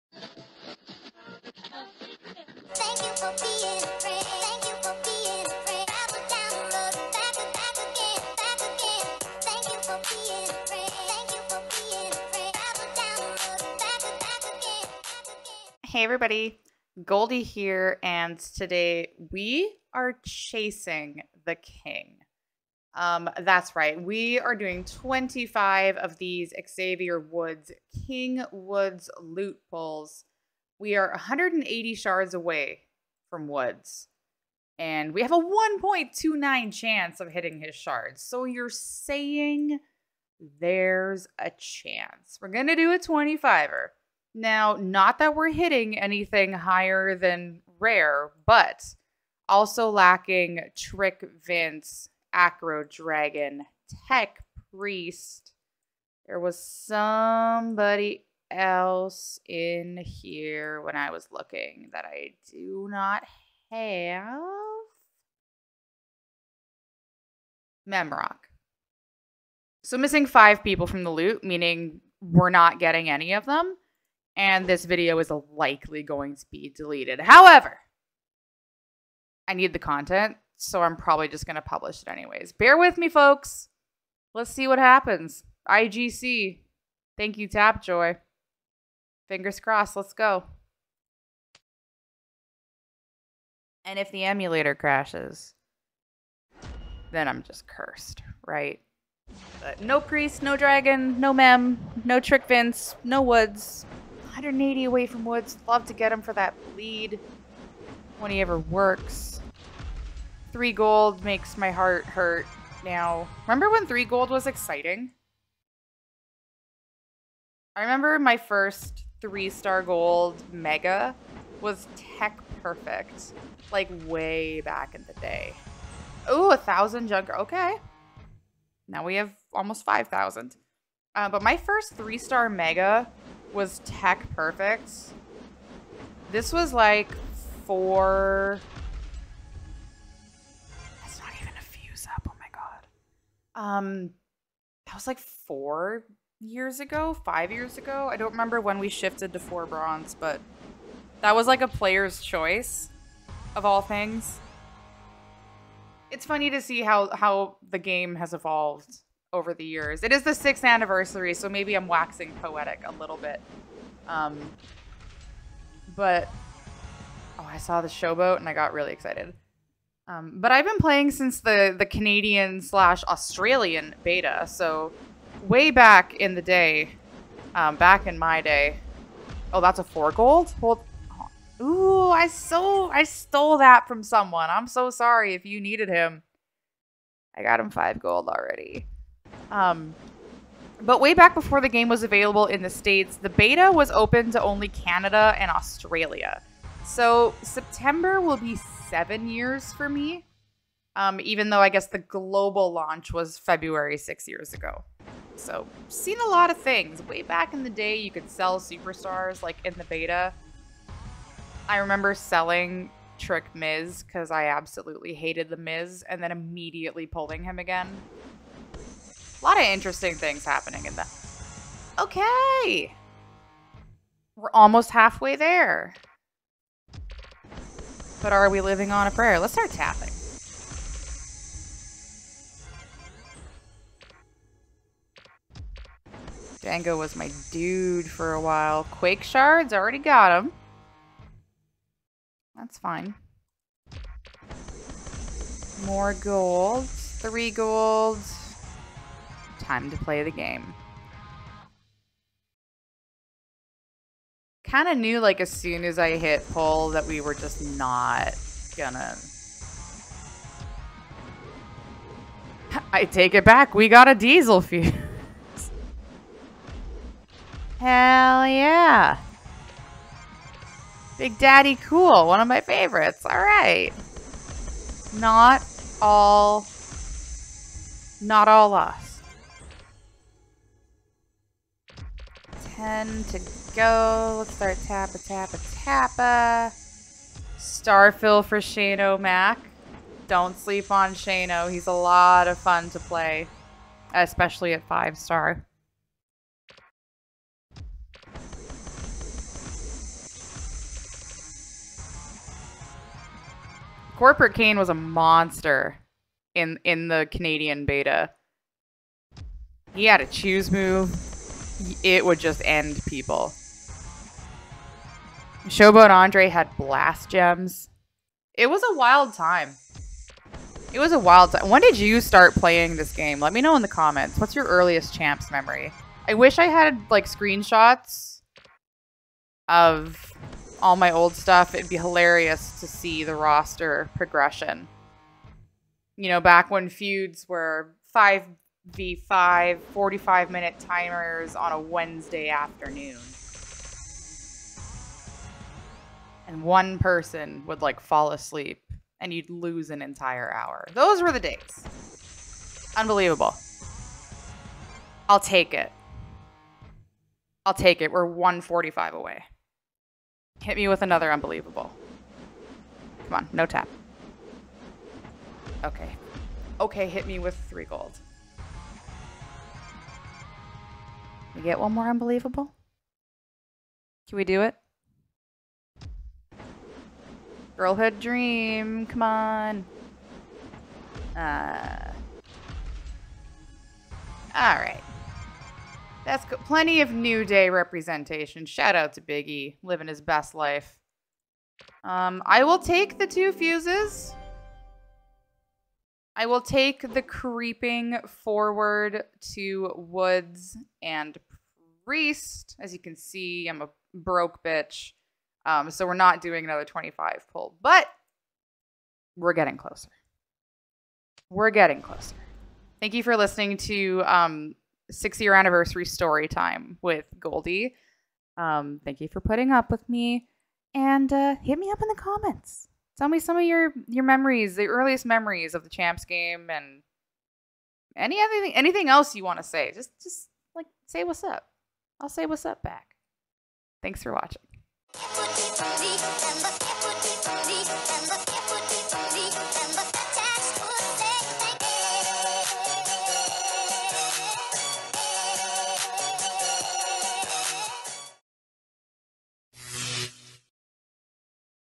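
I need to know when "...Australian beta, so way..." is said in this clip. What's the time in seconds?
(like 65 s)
173 s.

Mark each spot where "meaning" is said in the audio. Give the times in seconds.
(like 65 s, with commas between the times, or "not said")
71 s.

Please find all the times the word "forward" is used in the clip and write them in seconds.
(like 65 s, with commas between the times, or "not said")
398 s.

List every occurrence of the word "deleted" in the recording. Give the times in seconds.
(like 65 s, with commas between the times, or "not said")
76 s.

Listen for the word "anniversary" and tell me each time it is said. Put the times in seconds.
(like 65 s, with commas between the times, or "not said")
160 s, 415 s.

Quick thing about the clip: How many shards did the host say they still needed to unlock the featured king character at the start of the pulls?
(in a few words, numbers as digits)
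180.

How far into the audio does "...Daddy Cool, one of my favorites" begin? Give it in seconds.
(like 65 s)
271 s.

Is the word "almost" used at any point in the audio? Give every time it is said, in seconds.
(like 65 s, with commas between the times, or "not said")
129 s, 224 s.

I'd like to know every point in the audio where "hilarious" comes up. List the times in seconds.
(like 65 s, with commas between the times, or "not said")
331 s.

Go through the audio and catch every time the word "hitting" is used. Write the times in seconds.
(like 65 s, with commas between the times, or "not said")
37 s, 45 s.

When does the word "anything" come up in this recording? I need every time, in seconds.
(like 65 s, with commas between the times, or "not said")
45 s, 428 s.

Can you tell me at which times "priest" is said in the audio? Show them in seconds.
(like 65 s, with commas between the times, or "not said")
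54 s, 99 s, 402 s.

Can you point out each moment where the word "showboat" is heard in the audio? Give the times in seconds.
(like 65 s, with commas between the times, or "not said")
167 s, 315 s.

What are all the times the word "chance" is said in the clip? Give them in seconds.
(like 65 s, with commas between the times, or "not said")
36 s, 41 s.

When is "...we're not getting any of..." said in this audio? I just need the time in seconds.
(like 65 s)
72 s.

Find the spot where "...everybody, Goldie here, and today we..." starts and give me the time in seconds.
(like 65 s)
16 s.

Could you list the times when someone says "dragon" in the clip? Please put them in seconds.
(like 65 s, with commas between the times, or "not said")
52 s, 100 s.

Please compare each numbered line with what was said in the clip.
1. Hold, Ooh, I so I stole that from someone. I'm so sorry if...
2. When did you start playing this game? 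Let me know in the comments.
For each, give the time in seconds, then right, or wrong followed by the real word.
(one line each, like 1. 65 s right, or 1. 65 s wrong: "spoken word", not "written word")
1. 180 s right
2. 321 s right.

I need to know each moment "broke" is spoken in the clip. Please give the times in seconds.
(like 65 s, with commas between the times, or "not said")
404 s.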